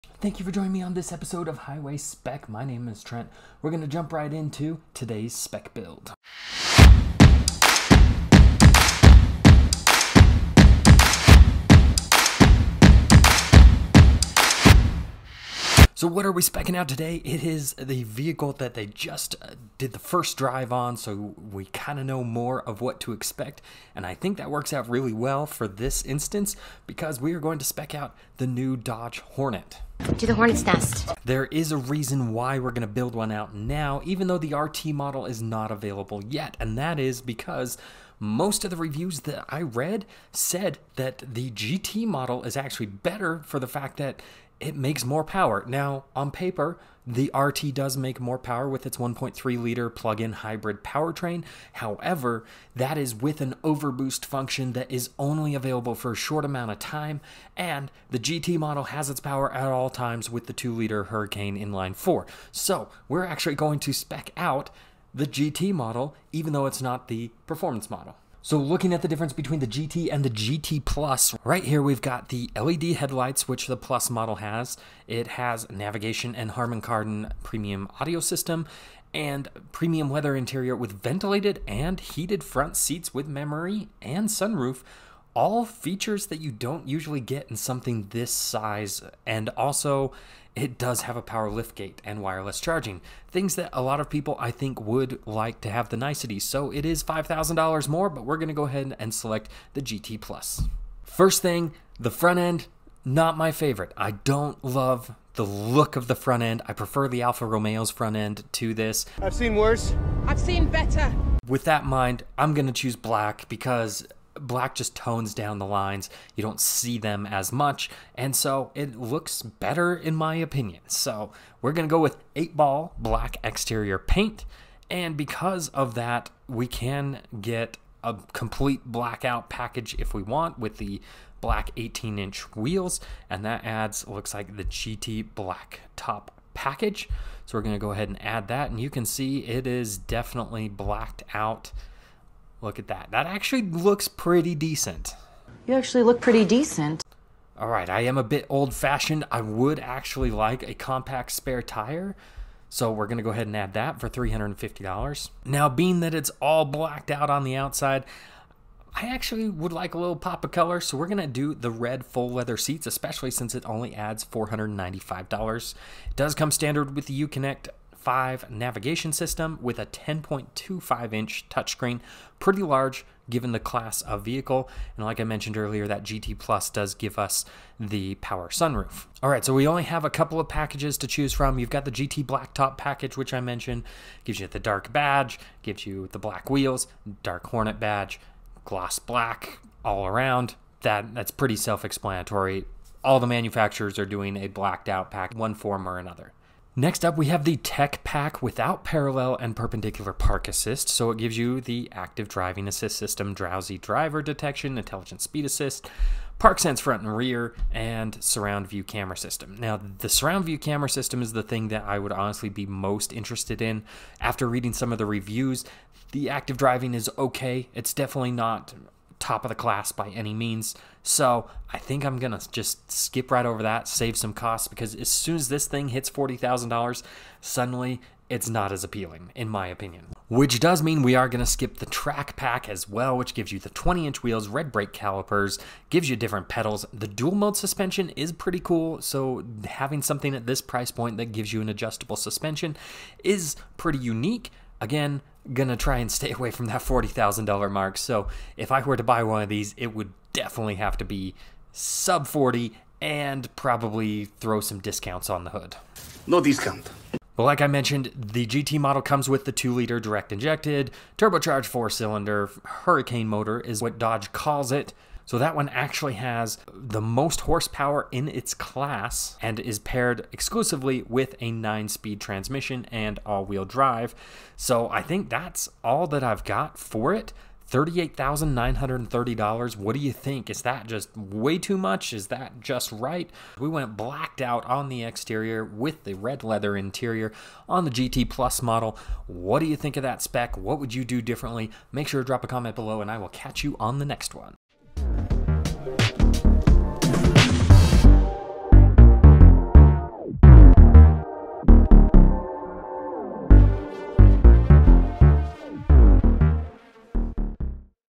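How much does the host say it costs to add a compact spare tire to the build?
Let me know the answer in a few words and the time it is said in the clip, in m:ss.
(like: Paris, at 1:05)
$350, at 2:34.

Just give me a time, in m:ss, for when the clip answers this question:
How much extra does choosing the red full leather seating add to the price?
2:44.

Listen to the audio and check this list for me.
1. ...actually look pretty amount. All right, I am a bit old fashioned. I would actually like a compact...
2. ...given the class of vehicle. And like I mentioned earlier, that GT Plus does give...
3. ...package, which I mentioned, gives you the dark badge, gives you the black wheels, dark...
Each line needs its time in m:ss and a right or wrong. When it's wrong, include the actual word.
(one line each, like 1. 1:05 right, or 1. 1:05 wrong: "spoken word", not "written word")
1. 2:25 wrong: "decent", not "amount"
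2. 2:53 right
3. 3:02 right.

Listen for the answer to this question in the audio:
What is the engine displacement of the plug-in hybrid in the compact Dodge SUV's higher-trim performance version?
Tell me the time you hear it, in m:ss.
0:48.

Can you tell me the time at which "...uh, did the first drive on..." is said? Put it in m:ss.
0:19.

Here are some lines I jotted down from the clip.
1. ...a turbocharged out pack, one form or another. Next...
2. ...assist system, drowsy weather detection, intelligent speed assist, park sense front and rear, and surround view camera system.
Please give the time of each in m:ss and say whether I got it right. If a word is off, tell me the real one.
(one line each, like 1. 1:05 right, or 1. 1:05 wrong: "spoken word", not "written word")
1. 3:14 wrong: "blacked", not "turbocharged"
2. 3:22 wrong: "driver", not "weather".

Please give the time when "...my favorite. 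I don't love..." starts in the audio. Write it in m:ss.
1:43.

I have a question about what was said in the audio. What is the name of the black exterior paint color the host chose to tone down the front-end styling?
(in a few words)
8 ball black.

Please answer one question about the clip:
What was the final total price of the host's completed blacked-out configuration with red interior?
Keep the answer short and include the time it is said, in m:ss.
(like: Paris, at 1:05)
$38,930, at 4:37.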